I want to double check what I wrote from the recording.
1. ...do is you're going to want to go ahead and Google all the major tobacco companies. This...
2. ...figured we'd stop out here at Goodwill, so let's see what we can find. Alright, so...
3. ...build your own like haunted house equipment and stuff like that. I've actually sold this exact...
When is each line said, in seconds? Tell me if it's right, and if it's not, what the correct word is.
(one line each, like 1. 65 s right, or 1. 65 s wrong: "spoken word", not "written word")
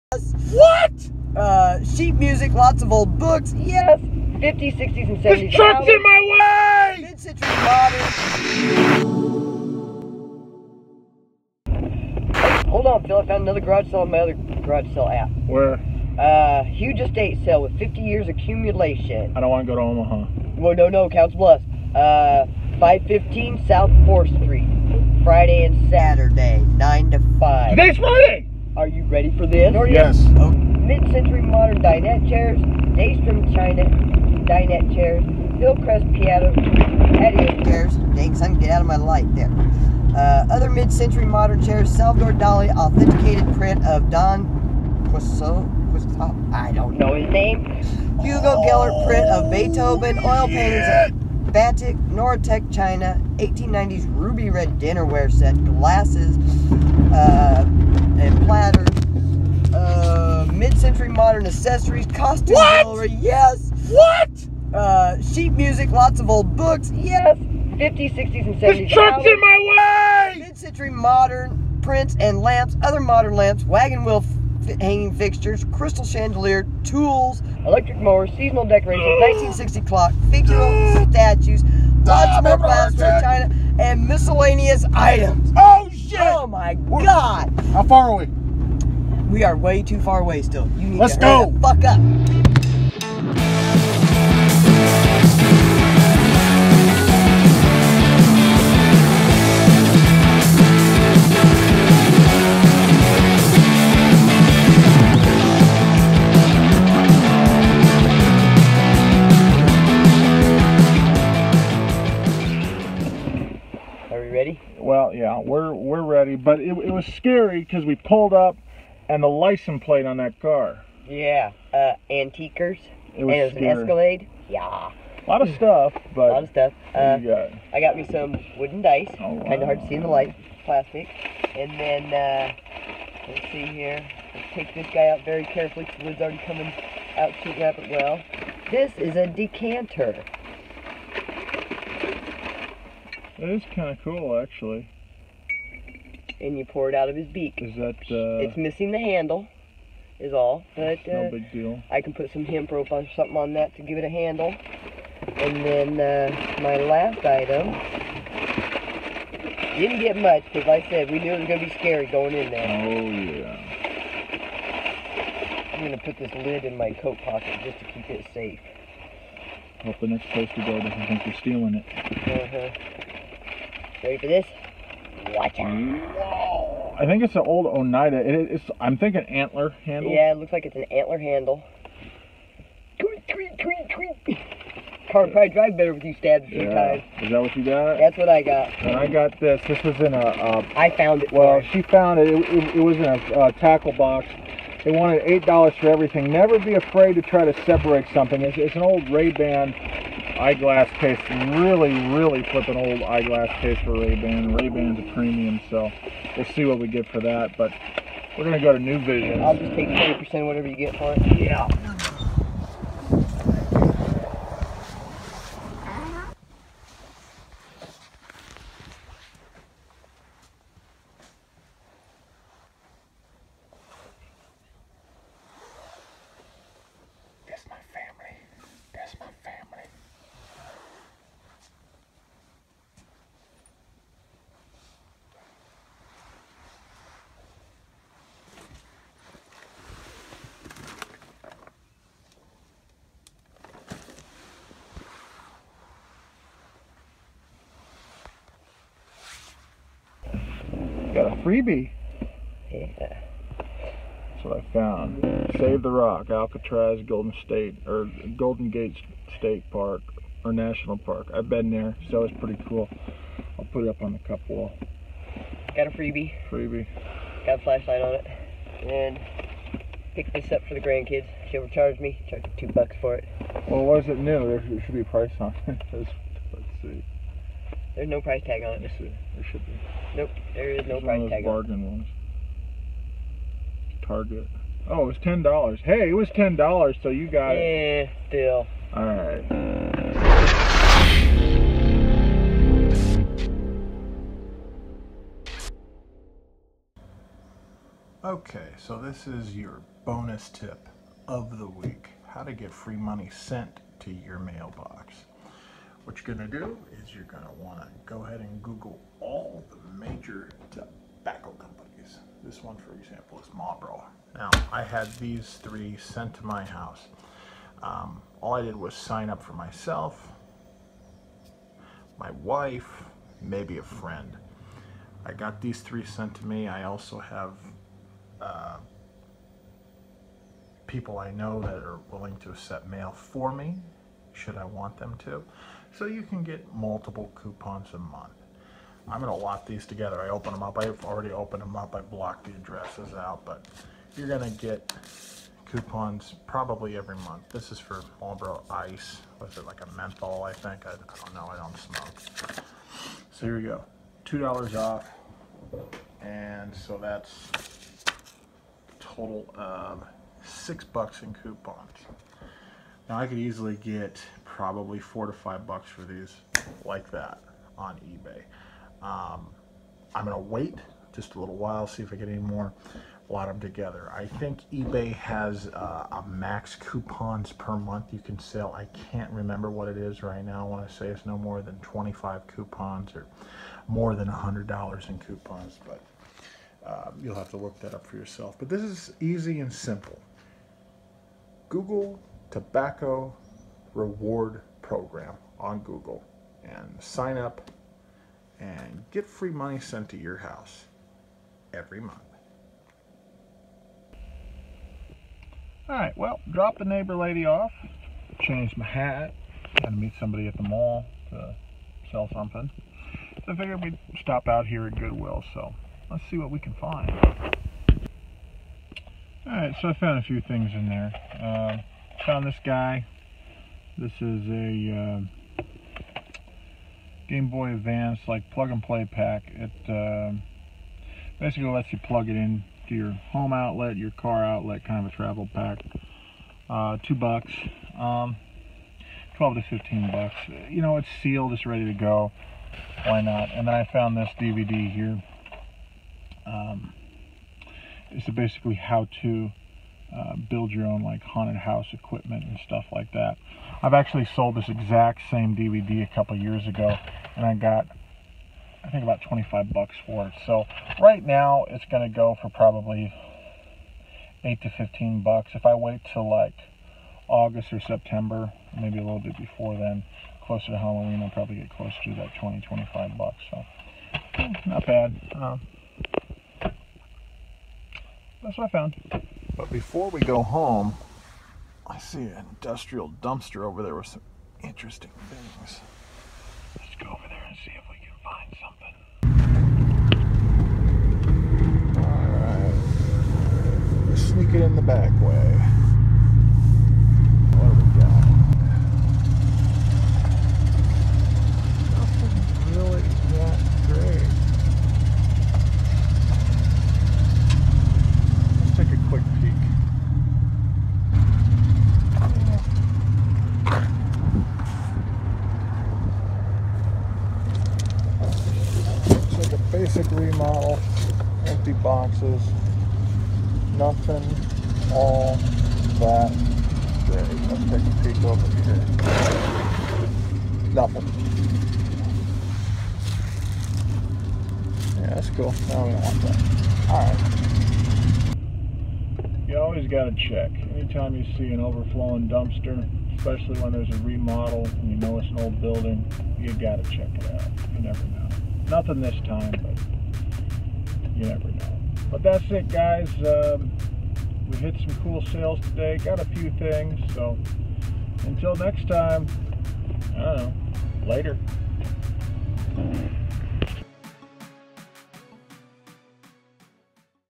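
1. 306 s right
2. 413 s right
3. 450 s right.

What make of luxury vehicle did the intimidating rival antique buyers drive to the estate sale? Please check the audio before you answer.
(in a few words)
Escalade.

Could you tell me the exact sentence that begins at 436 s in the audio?
Uh, two bucks, um, 12 to 15 bucks.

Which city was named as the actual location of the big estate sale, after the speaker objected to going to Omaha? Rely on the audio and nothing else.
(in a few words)
Council Bluffs.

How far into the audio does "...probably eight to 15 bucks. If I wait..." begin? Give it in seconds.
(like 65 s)
462 s.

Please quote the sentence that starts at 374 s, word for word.
I think eBay has uh, a max coupons per month you can sell.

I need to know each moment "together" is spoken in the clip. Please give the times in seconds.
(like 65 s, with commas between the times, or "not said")
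339 s, 373 s.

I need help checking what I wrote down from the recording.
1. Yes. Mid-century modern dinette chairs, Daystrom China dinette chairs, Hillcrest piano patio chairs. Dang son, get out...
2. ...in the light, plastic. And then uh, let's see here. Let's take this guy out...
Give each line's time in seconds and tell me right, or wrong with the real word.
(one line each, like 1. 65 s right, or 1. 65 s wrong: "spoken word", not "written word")
1. 29 s right
2. 129 s right.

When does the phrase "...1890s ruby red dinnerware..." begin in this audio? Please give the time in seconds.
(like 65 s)
53 s.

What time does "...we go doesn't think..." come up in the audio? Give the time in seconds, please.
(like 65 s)
170 s.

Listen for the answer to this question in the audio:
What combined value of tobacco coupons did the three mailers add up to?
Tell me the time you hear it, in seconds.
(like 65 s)
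360 s.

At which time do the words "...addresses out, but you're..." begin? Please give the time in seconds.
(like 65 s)
342 s.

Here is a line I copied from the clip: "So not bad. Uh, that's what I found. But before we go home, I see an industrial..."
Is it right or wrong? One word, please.
right.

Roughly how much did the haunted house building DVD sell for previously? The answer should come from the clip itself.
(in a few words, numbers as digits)
$25.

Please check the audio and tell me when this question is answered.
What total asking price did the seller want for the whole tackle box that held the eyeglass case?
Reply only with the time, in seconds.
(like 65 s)
195 s.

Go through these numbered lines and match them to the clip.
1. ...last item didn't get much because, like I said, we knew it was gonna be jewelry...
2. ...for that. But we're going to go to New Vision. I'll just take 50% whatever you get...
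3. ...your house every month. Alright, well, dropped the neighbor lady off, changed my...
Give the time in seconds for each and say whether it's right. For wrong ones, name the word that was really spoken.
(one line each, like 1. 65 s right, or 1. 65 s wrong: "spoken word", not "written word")
1. 156 s wrong: "scary", not "jewelry"
2. 207 s wrong: "20", not "50"
3. 400 s right.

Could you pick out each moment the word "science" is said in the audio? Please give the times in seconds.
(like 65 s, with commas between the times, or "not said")
not said.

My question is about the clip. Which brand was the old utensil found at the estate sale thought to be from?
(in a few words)
Oneida.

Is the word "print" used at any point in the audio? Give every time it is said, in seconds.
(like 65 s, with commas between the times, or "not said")
43 s, 49 s, 71 s.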